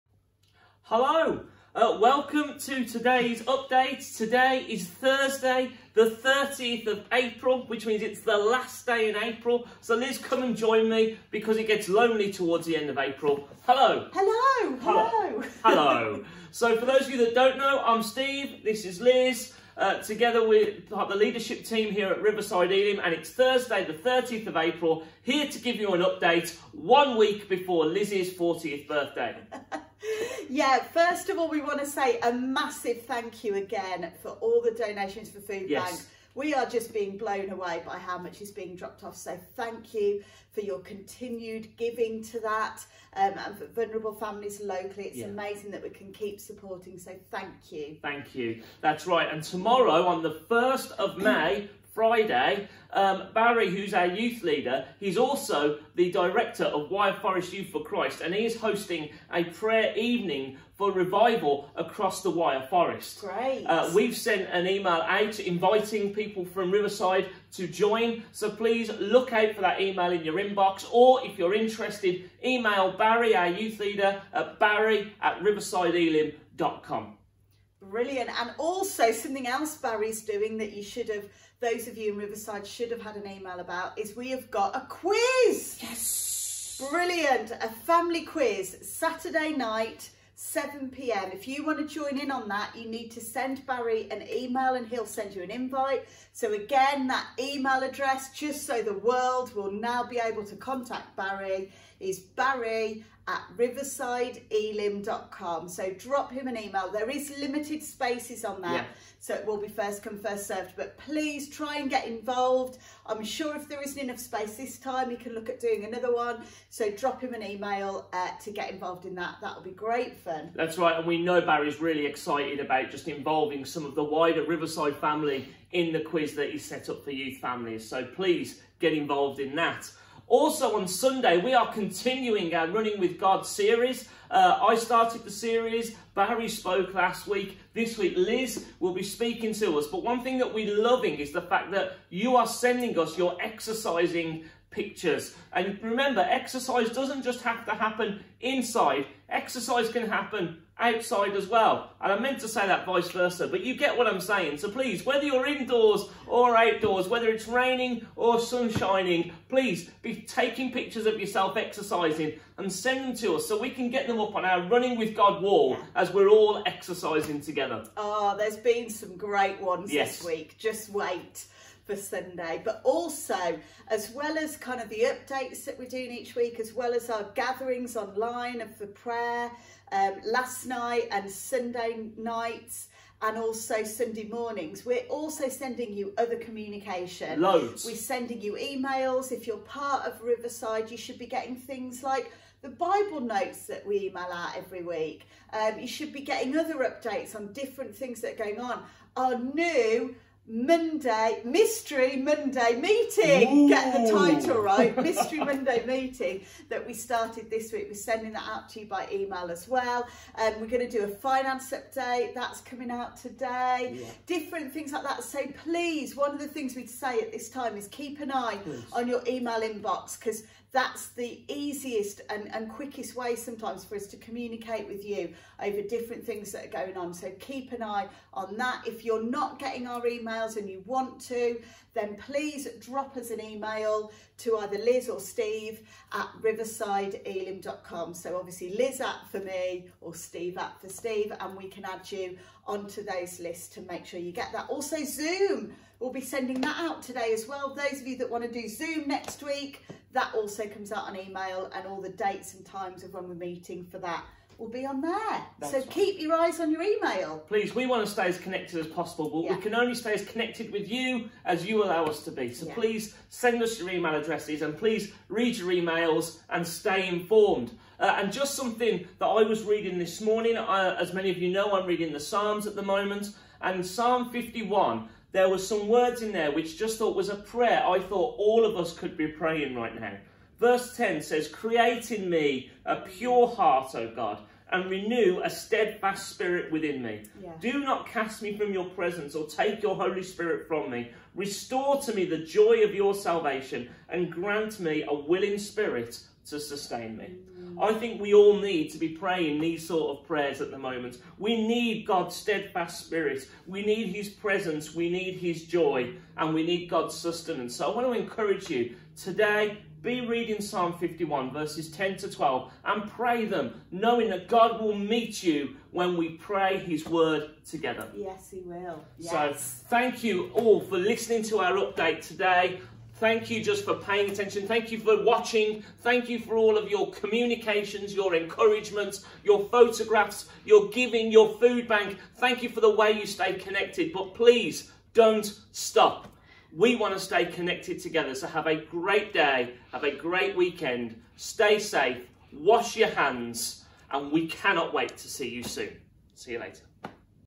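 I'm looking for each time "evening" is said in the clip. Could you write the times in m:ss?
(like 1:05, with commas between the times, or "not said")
0:59.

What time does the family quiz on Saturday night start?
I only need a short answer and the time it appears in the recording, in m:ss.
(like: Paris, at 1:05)
7 p.m., at 1:30.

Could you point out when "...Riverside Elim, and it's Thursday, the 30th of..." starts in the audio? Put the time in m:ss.
0:22.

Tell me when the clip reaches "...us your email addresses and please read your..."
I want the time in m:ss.
4:23.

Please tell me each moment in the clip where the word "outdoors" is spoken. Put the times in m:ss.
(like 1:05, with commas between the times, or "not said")
2:36.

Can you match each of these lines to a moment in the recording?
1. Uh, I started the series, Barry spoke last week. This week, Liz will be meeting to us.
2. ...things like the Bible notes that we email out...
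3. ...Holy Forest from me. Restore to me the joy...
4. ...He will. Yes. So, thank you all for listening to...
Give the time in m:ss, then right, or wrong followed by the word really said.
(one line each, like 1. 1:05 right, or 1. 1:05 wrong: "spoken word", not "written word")
1. 2:14 wrong: "speaking", not "meeting"
2. 3:11 right
3. 4:49 wrong: "Spirit", not "Forest"
4. 5:18 right.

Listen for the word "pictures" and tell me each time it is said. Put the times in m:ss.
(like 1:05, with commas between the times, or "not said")
2:24, 2:40.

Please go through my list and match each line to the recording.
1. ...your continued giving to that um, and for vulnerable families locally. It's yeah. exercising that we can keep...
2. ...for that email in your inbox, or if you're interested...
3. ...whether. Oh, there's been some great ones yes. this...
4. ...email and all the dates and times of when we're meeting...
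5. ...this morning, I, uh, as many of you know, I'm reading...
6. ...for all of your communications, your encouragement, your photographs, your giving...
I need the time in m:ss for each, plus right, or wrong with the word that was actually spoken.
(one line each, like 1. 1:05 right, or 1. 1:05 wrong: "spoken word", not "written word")
1. 0:40 wrong: "amazing", not "exercising"
2. 1:09 right
3. 2:47 wrong: "together", not "whether"
4. 4:11 right
5. 4:29 right
6. 5:26 right.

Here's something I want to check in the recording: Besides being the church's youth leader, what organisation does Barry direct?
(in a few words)
Wyre Forest Youth for Christ.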